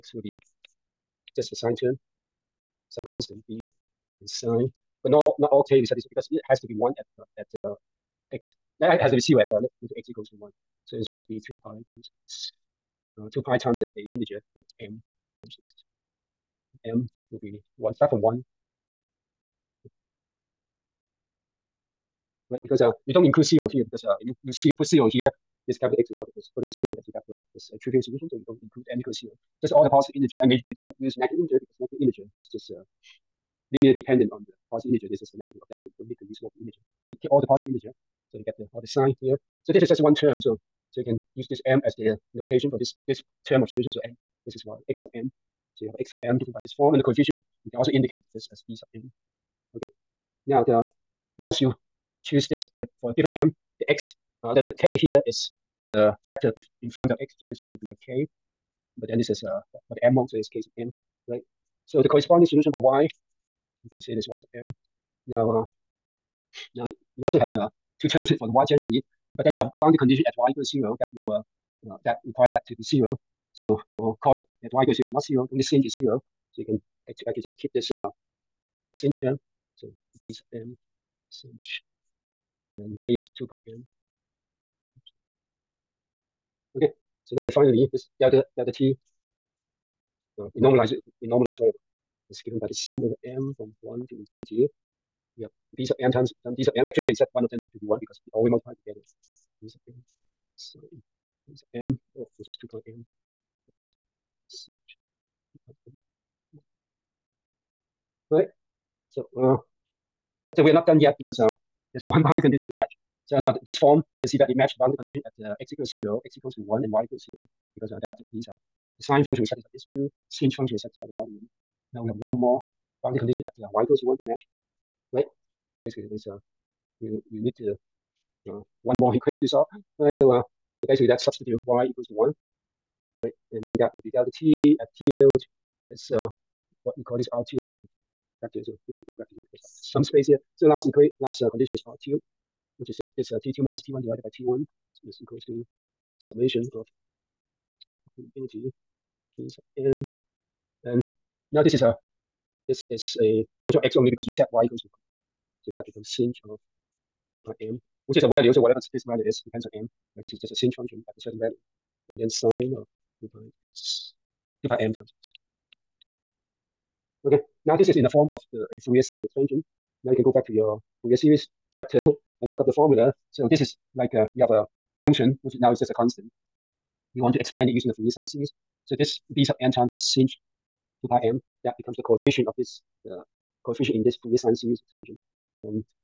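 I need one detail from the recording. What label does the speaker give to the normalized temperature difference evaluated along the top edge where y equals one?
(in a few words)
R2.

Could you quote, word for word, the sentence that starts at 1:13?
So for cos at y equals zero is not zero, only sin is zero.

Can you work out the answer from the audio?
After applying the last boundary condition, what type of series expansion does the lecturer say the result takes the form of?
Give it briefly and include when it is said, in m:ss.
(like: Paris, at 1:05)
Fourier sine expansion, at 2:48.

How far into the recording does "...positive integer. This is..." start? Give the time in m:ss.
0:34.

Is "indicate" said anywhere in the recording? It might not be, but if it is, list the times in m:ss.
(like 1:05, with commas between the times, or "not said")
0:47.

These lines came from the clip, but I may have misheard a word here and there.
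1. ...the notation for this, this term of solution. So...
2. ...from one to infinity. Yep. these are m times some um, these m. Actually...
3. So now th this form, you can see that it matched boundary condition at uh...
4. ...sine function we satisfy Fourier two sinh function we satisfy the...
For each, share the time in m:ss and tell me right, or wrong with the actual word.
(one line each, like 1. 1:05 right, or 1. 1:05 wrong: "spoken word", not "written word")
1. 0:41 right
2. 1:33 right
3. 1:53 right
4. 1:58 wrong: "These", not "Fourier".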